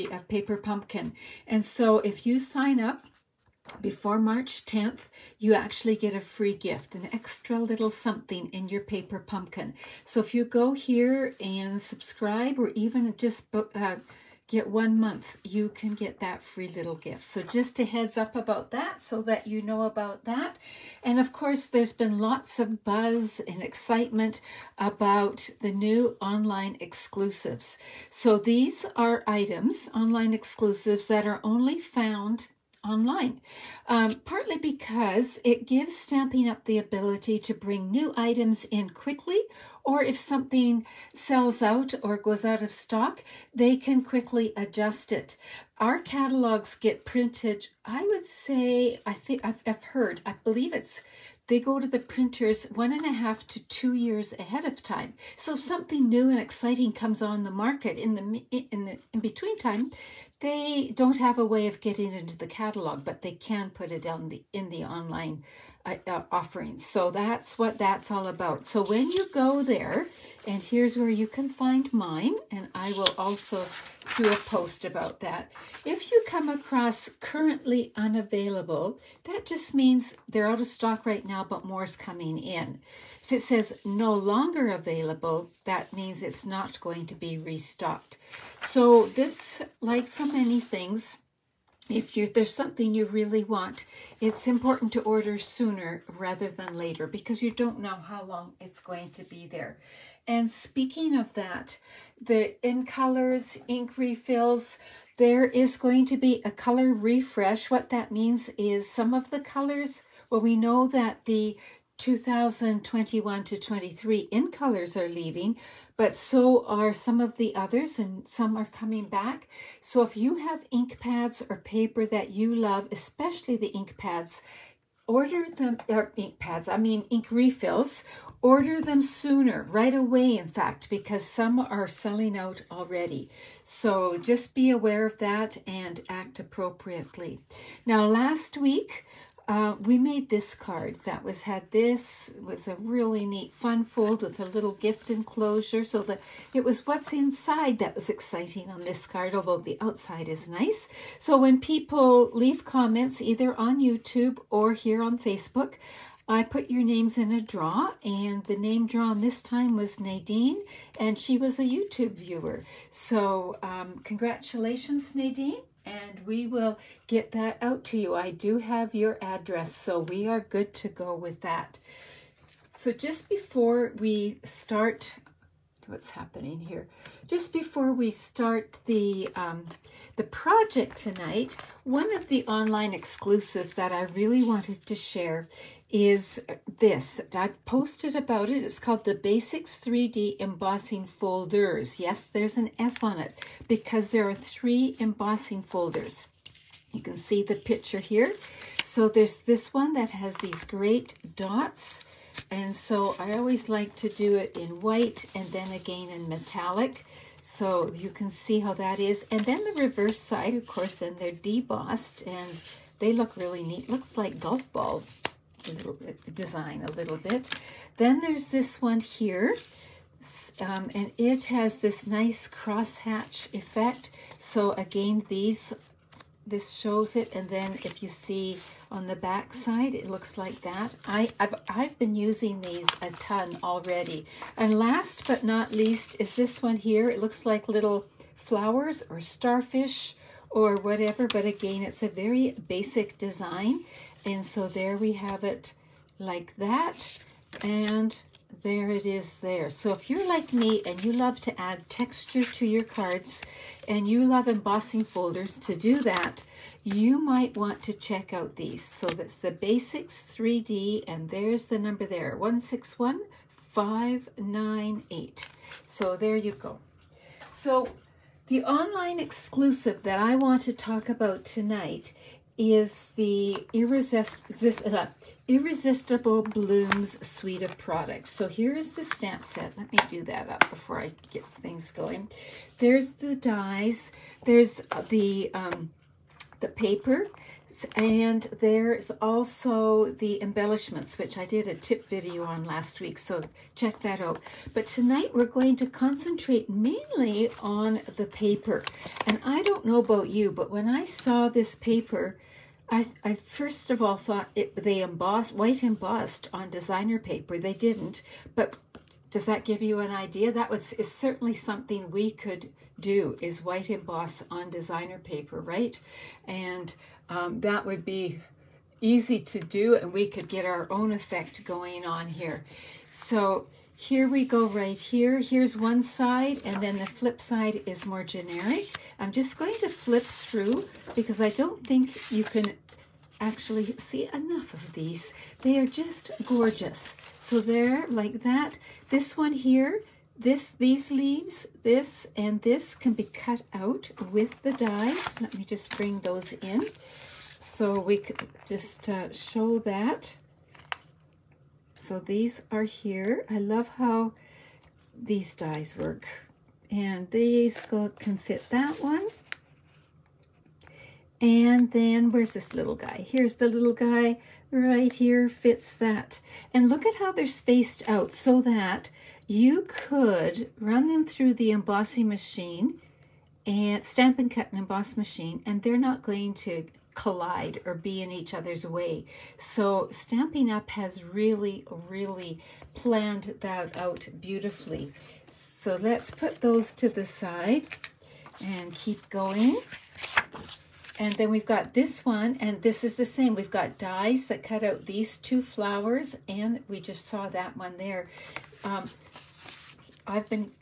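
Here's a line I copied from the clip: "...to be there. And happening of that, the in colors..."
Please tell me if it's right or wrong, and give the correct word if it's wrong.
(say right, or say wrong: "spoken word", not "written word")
wrong: "speaking", not "happening".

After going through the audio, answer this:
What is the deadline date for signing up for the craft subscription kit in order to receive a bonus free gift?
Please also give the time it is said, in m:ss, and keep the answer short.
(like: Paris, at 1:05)
March 10th, at 0:04.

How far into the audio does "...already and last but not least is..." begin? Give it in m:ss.
3:53.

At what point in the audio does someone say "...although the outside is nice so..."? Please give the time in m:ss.
2:29.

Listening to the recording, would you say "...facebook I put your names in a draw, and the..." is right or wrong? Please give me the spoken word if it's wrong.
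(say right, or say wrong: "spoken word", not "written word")
right.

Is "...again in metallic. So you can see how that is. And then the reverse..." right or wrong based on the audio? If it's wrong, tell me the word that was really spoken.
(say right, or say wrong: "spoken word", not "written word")
right.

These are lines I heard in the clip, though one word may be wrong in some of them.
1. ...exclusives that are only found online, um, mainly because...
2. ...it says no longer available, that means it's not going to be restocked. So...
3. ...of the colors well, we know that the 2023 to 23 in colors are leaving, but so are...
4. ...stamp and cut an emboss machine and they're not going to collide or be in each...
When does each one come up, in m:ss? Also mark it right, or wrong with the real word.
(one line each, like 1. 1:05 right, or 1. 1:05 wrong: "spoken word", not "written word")
1. 0:30 wrong: "partly", not "mainly"
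2. 1:23 right
3. 1:49 wrong: "2021", not "2023"
4. 6:14 right.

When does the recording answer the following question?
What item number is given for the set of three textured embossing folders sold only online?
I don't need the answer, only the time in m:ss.
4:22.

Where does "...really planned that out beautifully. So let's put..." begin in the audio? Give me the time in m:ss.
6:21.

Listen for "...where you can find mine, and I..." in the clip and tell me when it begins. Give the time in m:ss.
1:10.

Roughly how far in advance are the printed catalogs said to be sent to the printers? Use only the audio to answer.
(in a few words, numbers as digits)
1.5 to 2 years.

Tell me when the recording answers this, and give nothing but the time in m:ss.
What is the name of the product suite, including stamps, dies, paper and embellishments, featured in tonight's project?
4:35.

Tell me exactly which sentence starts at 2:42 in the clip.
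So, um, congratulations, Nadine and we will get that out to you.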